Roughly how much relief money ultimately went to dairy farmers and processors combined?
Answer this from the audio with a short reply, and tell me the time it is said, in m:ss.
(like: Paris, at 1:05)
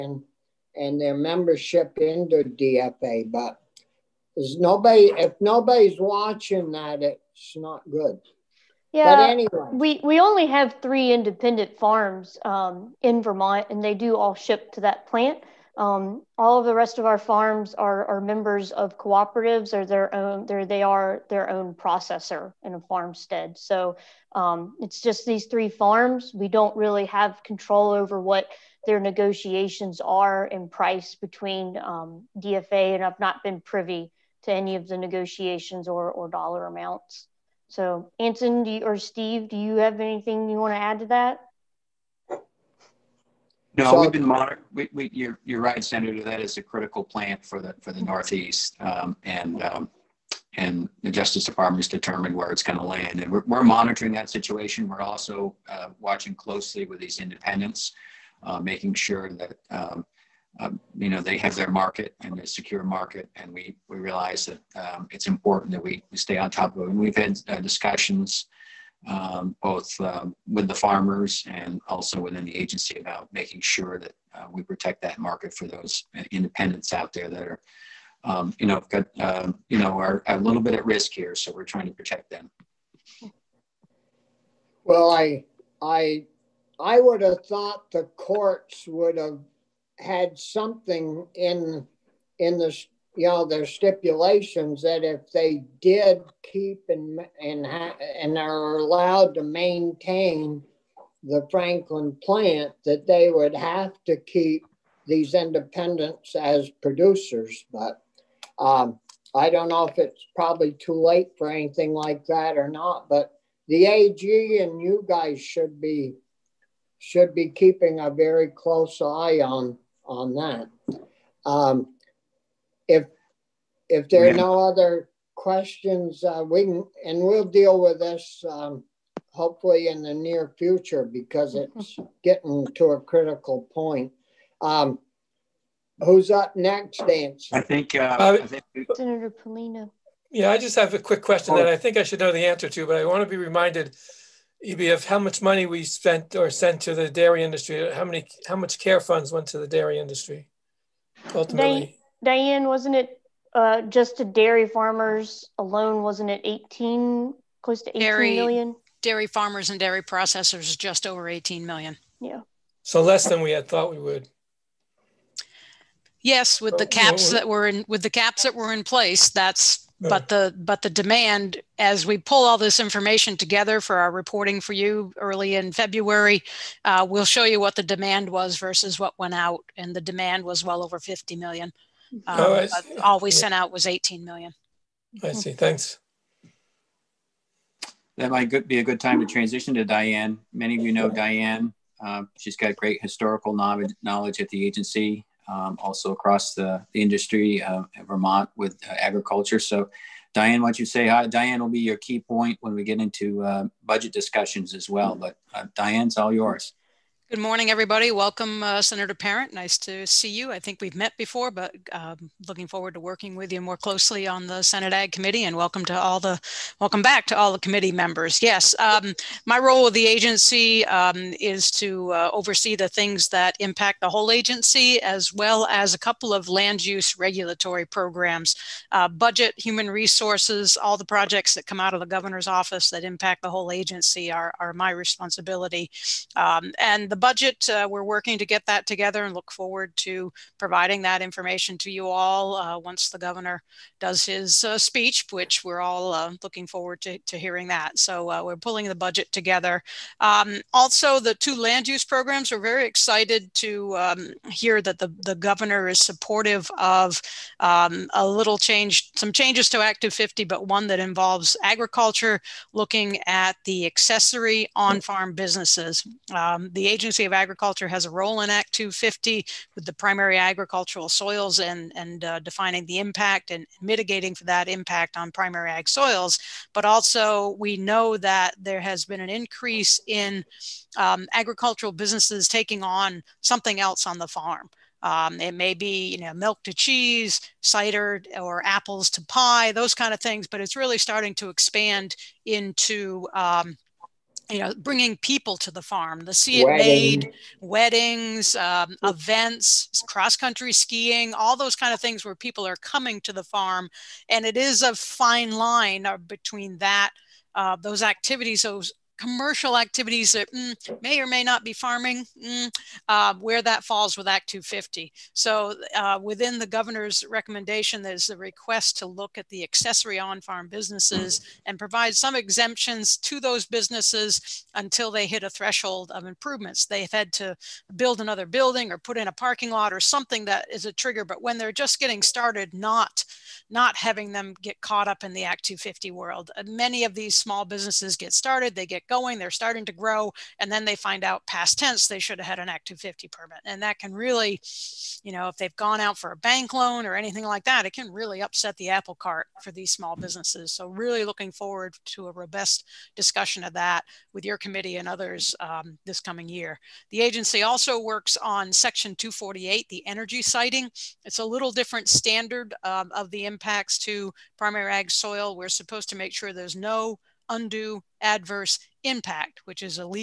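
just over $18 million, at 2:40.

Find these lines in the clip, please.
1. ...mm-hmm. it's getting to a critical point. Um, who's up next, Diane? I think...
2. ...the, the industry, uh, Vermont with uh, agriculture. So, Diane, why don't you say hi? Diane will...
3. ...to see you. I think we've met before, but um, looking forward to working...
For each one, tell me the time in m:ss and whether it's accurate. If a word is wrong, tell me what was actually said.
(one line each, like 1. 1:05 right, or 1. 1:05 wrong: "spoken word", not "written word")
1. 2:11 wrong: "Nancy", not "Diane"
2. 3:16 right
3. 3:29 right.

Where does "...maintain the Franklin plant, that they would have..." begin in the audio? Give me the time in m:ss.
1:39.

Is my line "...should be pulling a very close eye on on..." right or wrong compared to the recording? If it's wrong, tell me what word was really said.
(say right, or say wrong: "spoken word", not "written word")
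wrong: "keeping", not "pulling".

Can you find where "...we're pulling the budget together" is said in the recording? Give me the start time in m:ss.
4:08.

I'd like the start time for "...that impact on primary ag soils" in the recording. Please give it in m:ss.
4:34.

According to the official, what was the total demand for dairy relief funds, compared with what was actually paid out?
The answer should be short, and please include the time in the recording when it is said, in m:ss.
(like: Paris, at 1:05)
over $50 million, at 3:00.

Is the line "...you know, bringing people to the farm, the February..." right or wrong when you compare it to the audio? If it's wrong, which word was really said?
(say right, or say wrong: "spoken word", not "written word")
wrong: "Sea", not "February".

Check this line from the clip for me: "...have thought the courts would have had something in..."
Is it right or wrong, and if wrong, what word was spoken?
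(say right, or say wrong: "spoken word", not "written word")
right.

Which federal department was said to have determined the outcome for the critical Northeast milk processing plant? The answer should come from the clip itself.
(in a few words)
Justice Department.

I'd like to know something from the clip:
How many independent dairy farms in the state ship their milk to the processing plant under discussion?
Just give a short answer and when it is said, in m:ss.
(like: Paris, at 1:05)
3, at 0:10.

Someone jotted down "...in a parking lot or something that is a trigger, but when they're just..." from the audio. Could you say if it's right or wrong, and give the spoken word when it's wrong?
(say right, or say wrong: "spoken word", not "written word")
right.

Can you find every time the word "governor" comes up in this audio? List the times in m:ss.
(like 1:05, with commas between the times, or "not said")
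3:52, 4:03, 4:15, 5:16.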